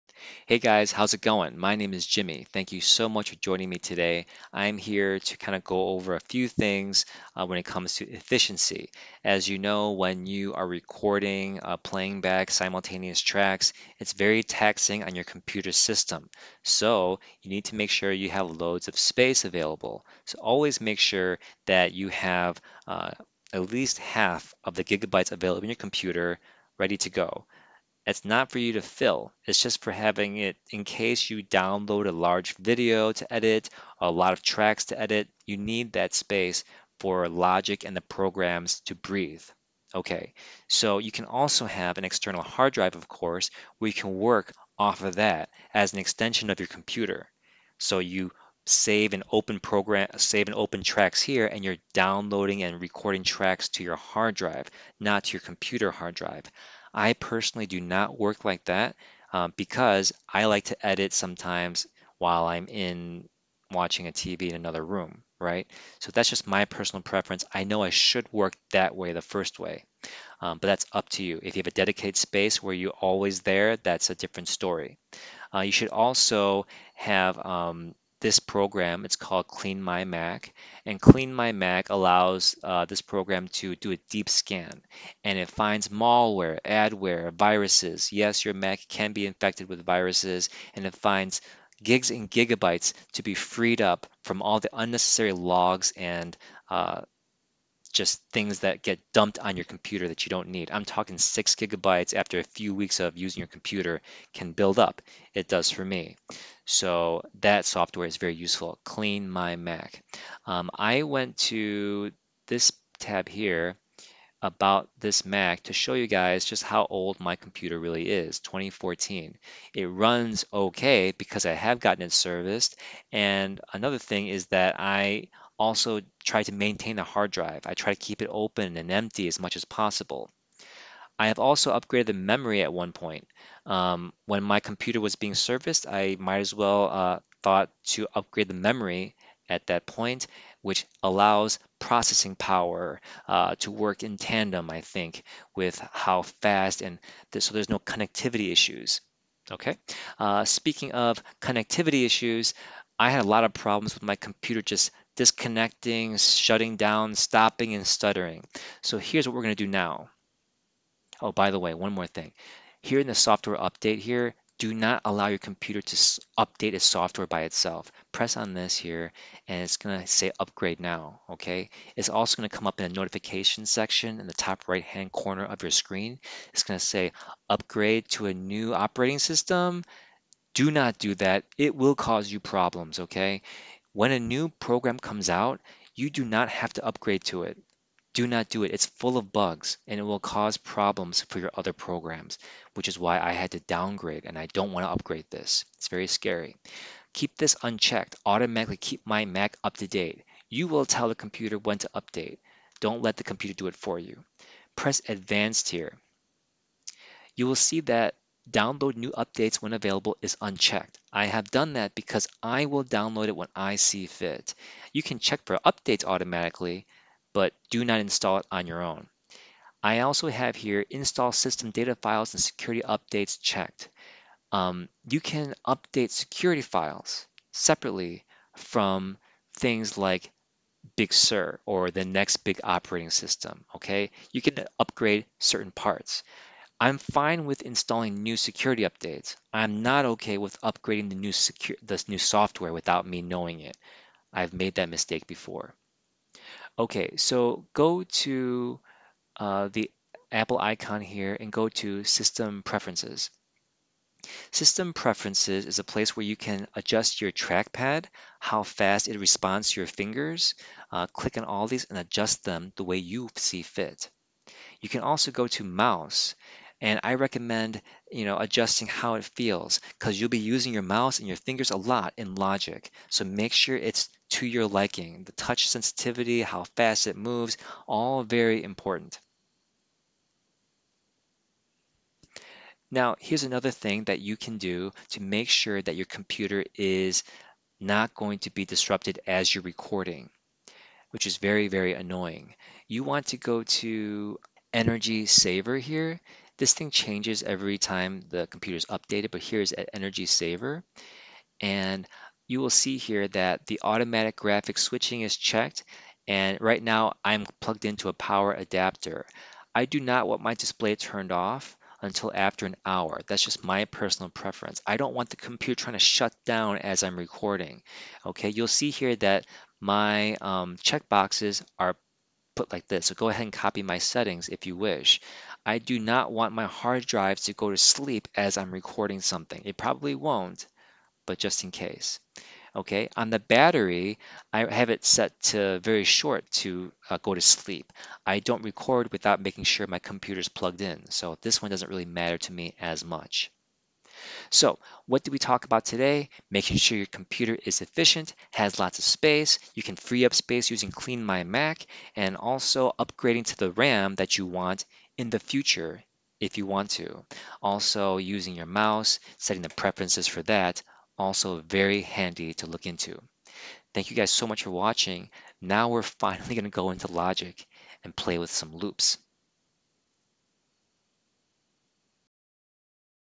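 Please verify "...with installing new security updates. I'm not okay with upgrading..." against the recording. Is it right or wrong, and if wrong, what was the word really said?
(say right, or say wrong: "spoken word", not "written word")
right.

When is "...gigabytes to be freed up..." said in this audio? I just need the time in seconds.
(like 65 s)
92 s.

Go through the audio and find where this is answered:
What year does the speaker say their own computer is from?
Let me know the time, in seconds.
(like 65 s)
118 s.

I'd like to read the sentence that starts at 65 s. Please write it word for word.
So that's just my personal preference.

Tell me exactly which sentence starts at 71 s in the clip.
If you have a dedicated space where you're always there, that's a different story.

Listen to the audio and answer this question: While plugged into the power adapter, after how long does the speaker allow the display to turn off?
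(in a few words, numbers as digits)
1 hour.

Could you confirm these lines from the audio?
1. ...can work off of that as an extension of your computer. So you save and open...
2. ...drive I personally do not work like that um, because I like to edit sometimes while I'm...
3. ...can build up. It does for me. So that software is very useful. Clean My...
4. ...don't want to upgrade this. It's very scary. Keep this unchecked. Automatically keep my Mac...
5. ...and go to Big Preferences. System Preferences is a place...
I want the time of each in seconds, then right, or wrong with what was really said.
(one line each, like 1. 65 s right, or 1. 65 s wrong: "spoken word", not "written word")
1. 43 s right
2. 56 s right
3. 104 s right
4. 194 s right
5. 251 s wrong: "System", not "Big".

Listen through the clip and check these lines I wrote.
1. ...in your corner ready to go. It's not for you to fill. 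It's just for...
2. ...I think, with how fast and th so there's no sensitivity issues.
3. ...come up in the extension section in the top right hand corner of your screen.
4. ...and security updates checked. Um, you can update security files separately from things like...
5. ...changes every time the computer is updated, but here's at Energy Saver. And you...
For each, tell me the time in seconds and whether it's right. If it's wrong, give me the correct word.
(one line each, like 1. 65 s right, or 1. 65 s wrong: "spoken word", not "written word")
1. 25 s wrong: "computer", not "corner"
2. 144 s wrong: "connectivity", not "sensitivity"
3. 172 s wrong: "notification", not "extension"
4. 222 s right
5. 296 s right.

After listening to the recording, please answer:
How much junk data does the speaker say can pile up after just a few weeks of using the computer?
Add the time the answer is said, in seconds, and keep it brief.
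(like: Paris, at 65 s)
6 gigabytes, at 101 s.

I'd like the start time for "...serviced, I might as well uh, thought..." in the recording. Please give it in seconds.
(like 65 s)
135 s.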